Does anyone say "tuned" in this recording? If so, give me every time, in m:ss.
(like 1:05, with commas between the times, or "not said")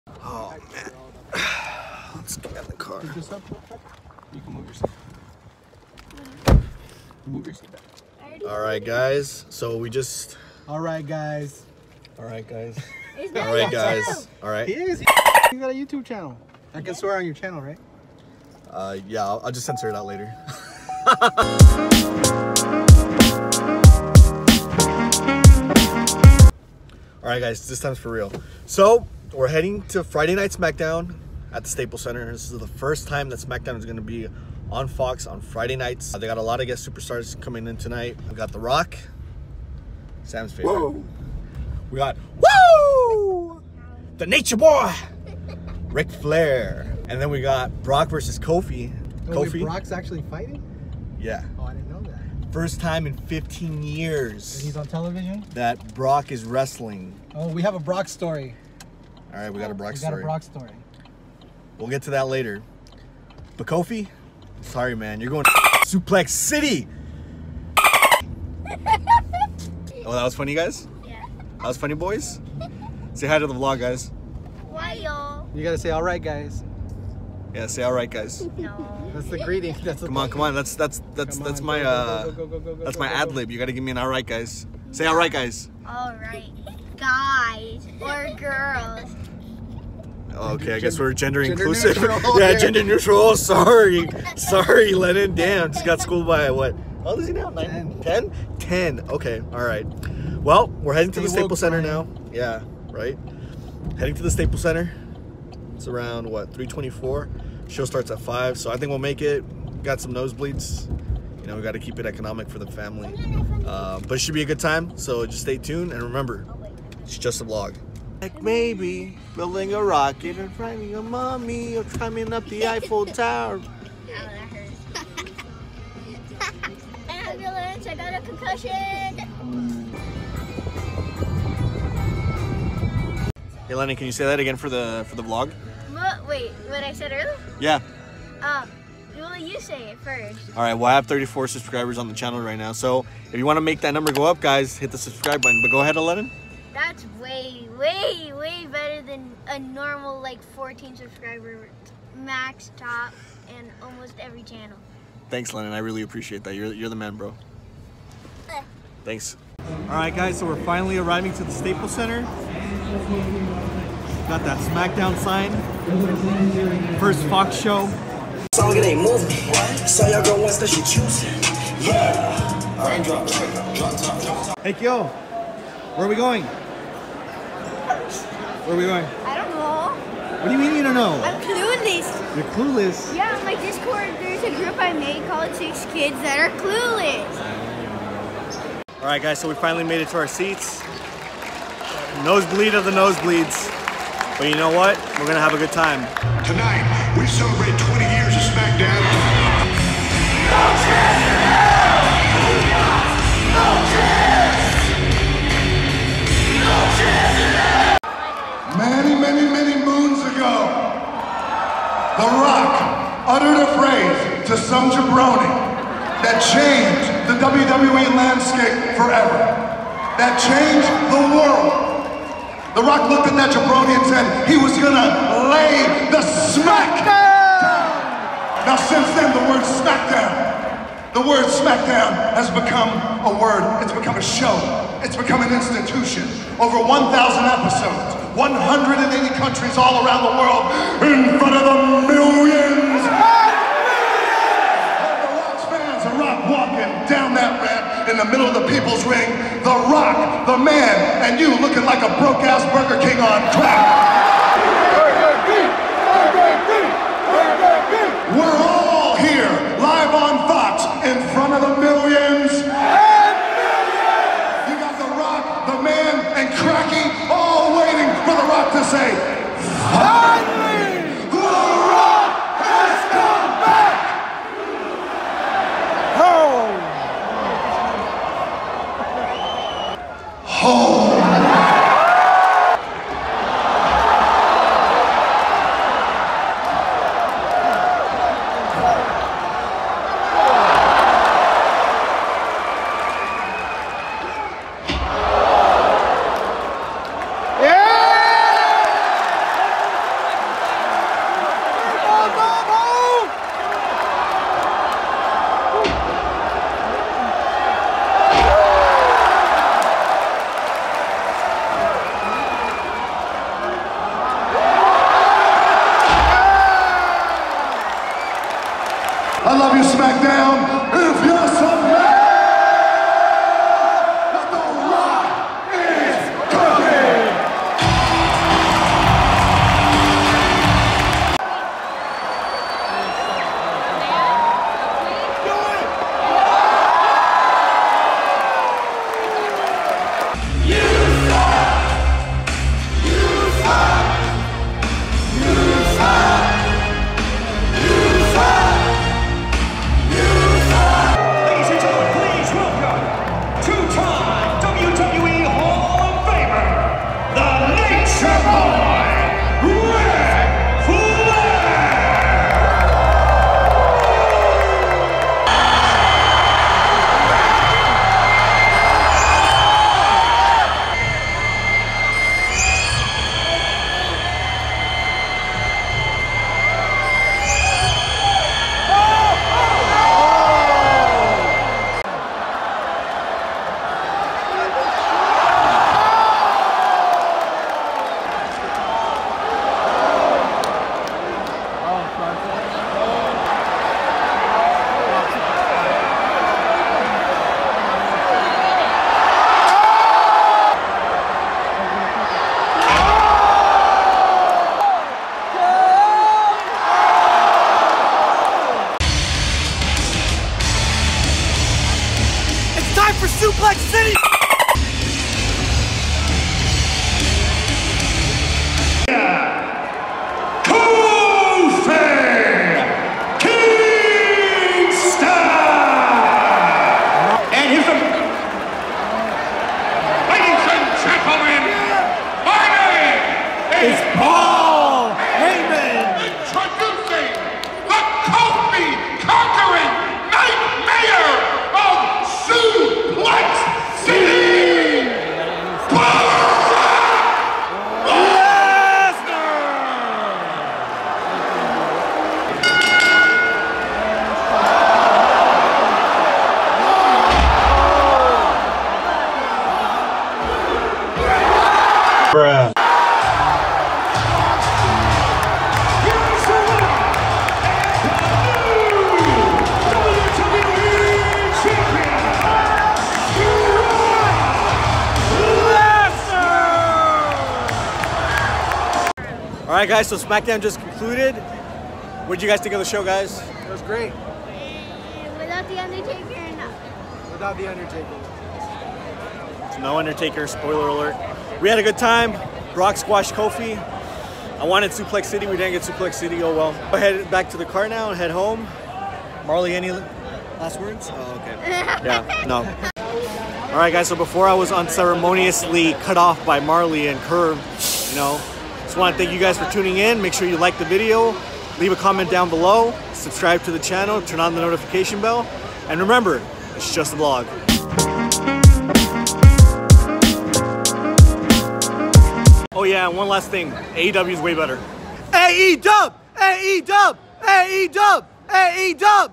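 1:55.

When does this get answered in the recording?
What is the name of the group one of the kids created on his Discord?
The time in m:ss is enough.
3:05.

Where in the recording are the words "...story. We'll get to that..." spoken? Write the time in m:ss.
1:00.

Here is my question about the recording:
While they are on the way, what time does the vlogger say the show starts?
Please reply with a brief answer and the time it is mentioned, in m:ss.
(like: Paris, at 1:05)
five, at 1:48.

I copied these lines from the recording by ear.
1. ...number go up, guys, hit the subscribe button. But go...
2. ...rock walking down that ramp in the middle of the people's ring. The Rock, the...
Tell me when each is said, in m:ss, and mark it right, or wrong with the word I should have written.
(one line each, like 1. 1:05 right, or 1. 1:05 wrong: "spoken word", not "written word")
1. 2:23 right
2. 4:06 right.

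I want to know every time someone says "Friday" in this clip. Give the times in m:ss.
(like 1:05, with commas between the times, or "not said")
0:30, 0:35.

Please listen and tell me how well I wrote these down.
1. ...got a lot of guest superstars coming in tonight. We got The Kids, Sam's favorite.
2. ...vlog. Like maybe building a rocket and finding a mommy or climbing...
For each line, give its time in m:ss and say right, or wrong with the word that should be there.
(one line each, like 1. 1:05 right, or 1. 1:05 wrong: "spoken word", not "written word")
1. 0:36 wrong: "Rock", not "Kids"
2. 1:57 right.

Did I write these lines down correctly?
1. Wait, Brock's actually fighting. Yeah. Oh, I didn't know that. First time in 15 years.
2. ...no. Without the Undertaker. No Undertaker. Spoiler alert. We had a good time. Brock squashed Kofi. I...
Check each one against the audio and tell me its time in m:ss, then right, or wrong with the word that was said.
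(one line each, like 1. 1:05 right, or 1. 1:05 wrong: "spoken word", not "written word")
1. 0:49 right
2. 8:06 right.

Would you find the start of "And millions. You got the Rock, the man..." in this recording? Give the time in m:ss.
4:22.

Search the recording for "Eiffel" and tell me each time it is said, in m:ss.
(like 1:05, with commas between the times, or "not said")
2:02.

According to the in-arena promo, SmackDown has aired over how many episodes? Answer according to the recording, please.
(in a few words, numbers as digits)
1,000.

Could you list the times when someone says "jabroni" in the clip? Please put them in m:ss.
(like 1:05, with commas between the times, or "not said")
3:34, 3:43.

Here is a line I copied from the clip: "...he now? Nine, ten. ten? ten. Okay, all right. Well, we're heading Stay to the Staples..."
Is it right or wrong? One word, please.
right.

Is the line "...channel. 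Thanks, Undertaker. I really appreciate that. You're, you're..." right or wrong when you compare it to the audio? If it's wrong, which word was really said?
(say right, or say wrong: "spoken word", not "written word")
wrong: "Lennon", not "Undertaker".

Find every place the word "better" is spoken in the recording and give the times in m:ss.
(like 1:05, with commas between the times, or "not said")
2:28, 8:44.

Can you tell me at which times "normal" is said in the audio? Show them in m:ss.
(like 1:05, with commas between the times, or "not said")
2:29.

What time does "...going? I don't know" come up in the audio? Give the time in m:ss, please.
2:58.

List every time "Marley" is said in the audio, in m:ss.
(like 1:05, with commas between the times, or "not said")
8:19, 8:26.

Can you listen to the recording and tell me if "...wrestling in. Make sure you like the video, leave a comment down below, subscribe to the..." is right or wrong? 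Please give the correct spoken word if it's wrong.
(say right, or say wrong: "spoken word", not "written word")
wrong: "tuning", not "wrestling".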